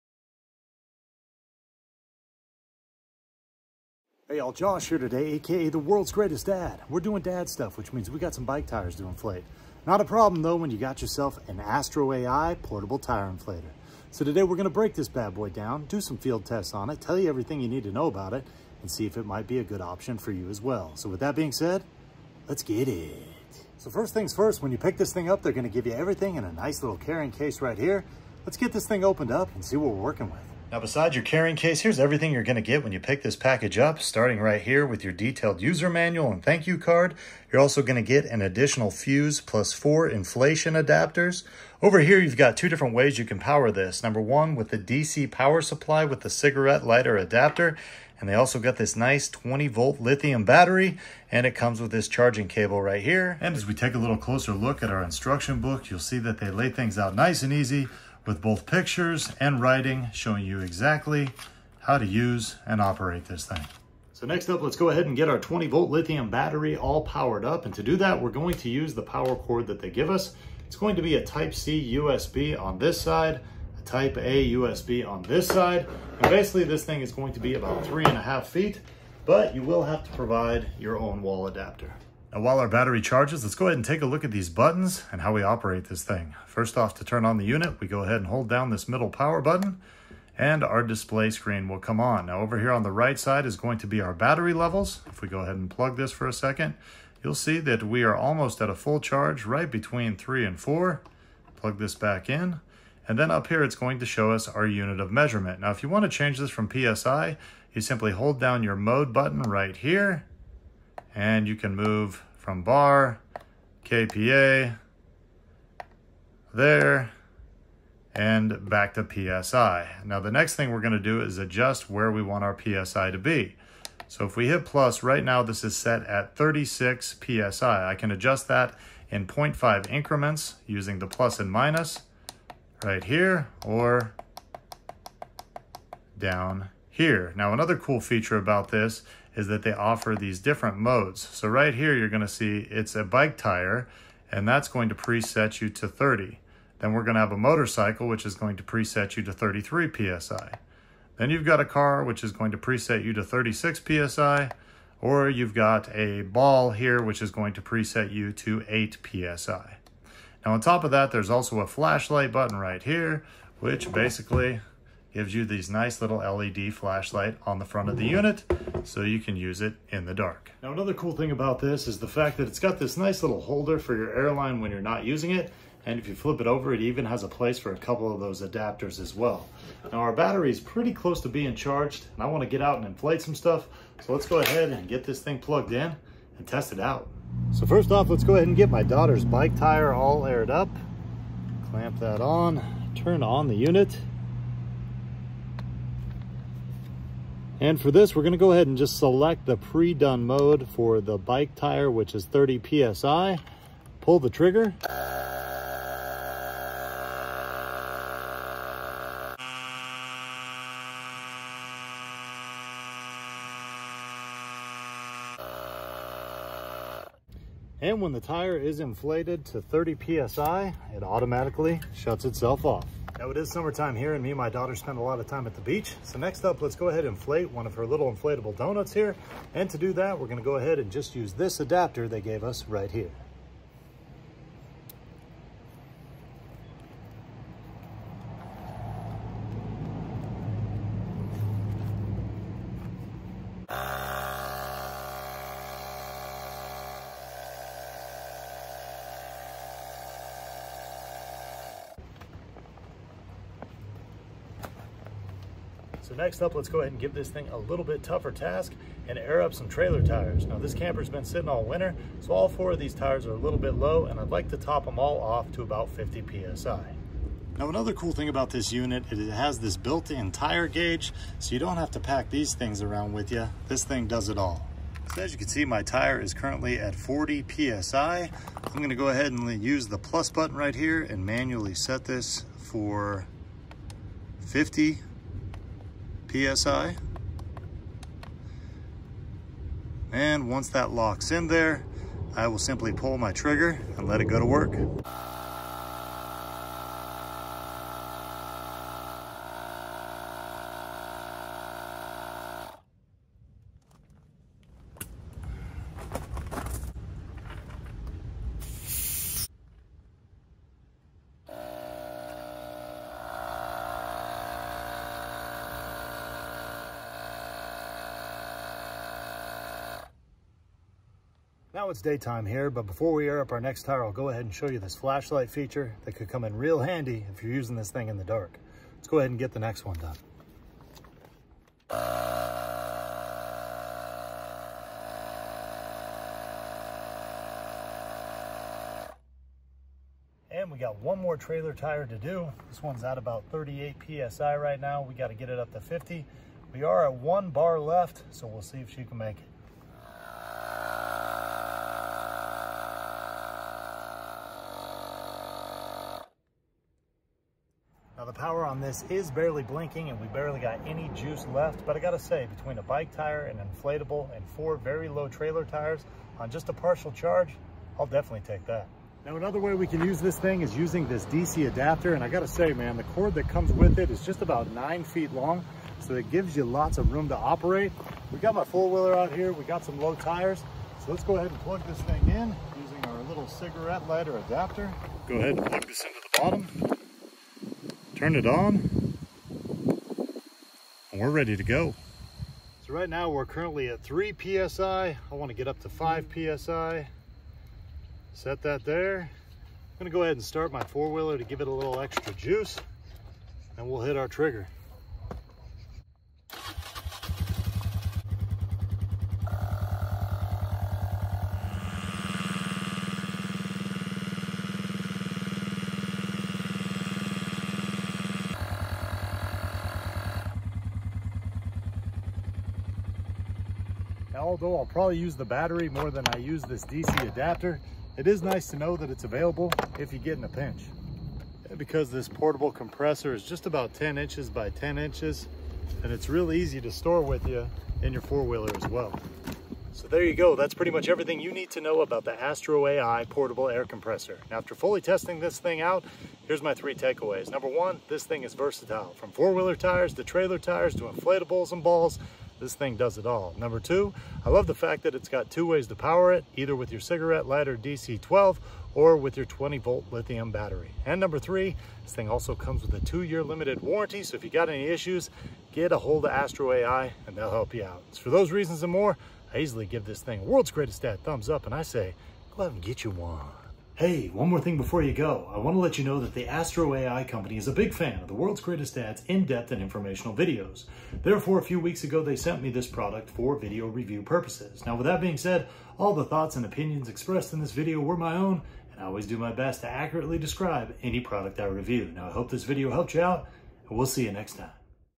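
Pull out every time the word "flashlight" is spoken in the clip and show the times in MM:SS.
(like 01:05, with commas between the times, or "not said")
02:41, 02:46, 05:24.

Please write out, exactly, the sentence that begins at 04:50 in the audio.
And once that locks in there, I will simply pull my trigger and let it go to work.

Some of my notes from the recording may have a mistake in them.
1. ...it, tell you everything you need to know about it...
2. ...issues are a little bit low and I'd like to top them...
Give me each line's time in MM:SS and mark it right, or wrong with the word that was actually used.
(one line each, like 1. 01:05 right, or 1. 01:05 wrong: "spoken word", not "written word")
1. 00:16 right
2. 04:22 wrong: "tires", not "issues".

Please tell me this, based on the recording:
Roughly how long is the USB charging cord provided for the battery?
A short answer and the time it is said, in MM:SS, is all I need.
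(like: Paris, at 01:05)
3.5 feet, at 01:17.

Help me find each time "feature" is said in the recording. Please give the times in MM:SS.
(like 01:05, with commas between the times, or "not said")
02:18, 05:25.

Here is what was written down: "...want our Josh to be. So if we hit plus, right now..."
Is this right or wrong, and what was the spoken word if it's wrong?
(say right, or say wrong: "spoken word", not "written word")
wrong: "PSI", not "Josh".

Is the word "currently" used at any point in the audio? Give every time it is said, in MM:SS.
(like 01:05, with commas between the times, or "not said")
04:36, 06:33.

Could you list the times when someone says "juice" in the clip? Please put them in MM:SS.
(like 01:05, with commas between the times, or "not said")
06:01, 06:42.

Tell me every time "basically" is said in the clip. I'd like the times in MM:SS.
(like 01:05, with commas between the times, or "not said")
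01:16, 02:43.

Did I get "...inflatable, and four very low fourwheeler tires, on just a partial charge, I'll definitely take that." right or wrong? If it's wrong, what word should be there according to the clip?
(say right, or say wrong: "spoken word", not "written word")
wrong: "trailer", not "fourwheeler".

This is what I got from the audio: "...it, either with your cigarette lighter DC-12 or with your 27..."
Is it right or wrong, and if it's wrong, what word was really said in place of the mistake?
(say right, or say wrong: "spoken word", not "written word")
wrong: "20", not "27".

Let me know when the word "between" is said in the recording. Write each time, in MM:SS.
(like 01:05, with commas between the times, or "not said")
01:39, 06:02.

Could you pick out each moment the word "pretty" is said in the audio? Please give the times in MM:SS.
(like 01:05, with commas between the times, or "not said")
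03:00, 07:20.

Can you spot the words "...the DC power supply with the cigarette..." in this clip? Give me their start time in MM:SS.
00:44.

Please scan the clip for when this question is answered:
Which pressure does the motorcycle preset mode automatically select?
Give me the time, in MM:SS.
02:29.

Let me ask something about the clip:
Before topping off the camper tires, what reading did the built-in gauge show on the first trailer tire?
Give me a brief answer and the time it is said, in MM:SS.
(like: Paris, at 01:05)
40 PSI, at 04:36.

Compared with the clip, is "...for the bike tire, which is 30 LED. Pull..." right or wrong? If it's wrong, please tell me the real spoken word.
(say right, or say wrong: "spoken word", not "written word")
wrong: "PSI", not "LED".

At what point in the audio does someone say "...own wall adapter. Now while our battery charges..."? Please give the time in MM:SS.
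01:20.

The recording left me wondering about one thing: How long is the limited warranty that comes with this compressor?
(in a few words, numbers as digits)
2 years.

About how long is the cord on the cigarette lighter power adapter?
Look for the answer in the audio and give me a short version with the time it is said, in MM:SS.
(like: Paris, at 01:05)
9 feet, at 06:14.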